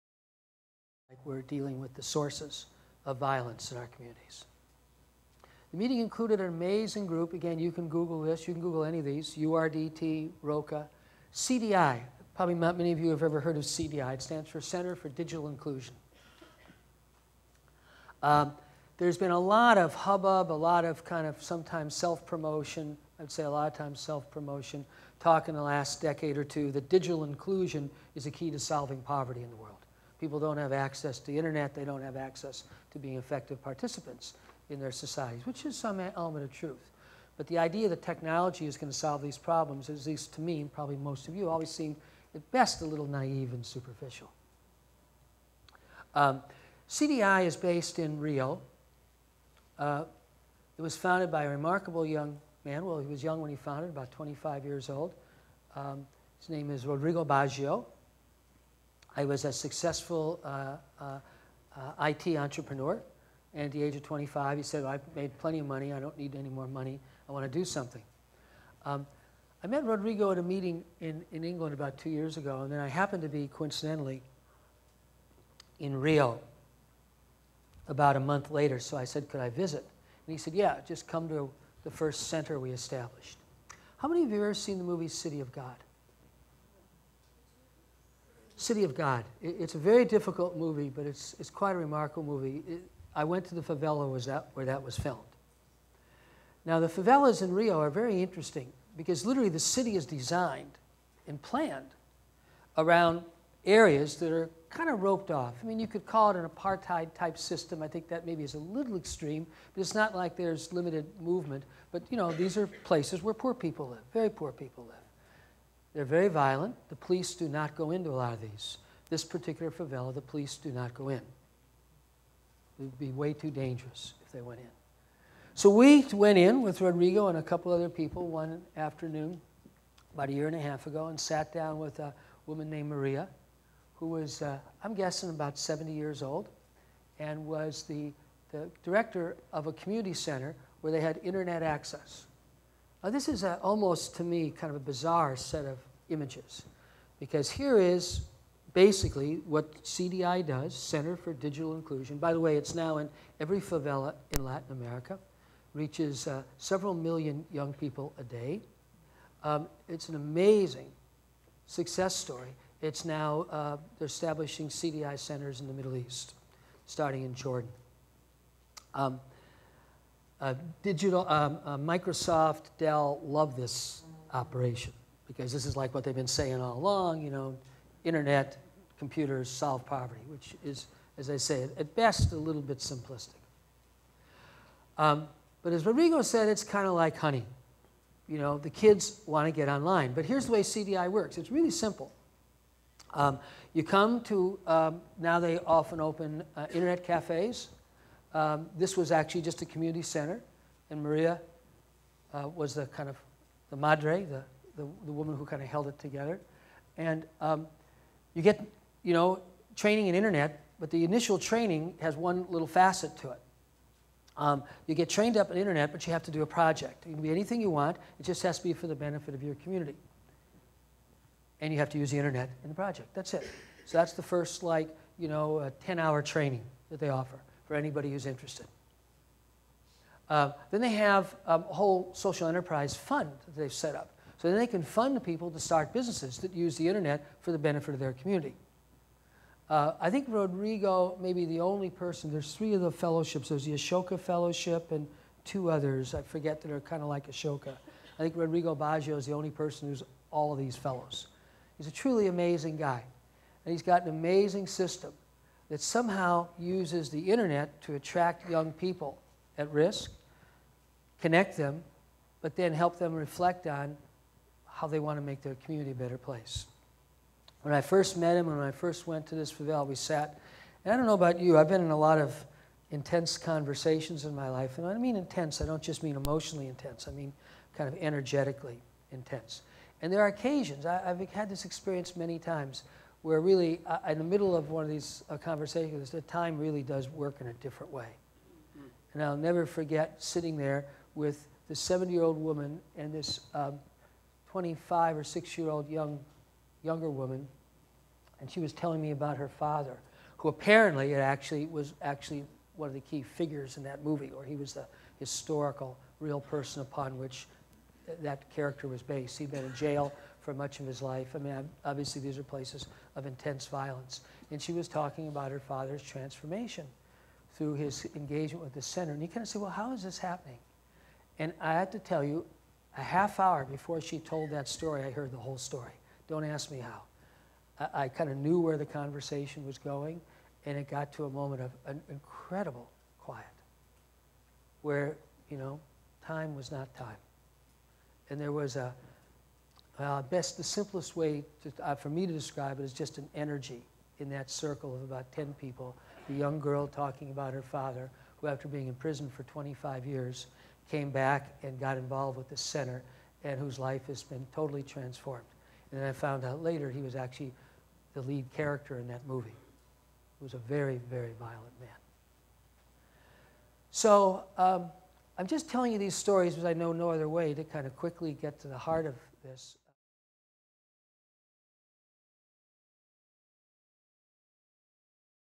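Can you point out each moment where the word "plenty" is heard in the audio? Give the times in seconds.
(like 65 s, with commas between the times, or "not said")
65 s.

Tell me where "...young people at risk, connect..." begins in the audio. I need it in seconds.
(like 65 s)
258 s.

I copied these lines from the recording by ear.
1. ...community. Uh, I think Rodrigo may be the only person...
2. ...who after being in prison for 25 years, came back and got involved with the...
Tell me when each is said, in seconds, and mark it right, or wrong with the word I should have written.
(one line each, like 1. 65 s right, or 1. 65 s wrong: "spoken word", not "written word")
1. 238 s right
2. 348 s right.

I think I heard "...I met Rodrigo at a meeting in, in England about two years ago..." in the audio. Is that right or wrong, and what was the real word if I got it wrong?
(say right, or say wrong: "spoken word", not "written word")
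right.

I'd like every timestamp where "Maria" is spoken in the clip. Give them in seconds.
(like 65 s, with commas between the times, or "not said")
132 s, 201 s.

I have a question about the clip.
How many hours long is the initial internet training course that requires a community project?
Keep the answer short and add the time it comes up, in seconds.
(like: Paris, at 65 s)
10, at 225 s.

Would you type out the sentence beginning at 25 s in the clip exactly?
Talk in the last decade or two that digital inclusion is a key to solving poverty in the world.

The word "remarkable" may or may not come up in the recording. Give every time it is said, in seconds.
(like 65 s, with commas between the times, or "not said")
51 s, 91 s.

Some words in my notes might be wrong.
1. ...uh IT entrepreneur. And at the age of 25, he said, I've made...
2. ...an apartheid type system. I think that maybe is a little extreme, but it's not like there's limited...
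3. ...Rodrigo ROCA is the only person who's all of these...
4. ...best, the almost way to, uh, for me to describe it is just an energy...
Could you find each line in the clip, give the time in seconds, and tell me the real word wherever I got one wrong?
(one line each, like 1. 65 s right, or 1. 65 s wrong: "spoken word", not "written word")
1. 61 s right
2. 106 s right
3. 248 s wrong: "Baggio", not "ROCA"
4. 340 s wrong: "simplest", not "almost".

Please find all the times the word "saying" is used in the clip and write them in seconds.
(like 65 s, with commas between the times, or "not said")
176 s.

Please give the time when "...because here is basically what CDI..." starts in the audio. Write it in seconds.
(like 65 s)
147 s.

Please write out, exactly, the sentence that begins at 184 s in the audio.
Um, but as Rodrigo said, it's kind of like honey.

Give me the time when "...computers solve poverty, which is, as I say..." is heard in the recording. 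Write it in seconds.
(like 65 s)
178 s.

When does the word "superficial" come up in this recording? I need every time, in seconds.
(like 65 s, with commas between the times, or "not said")
43 s.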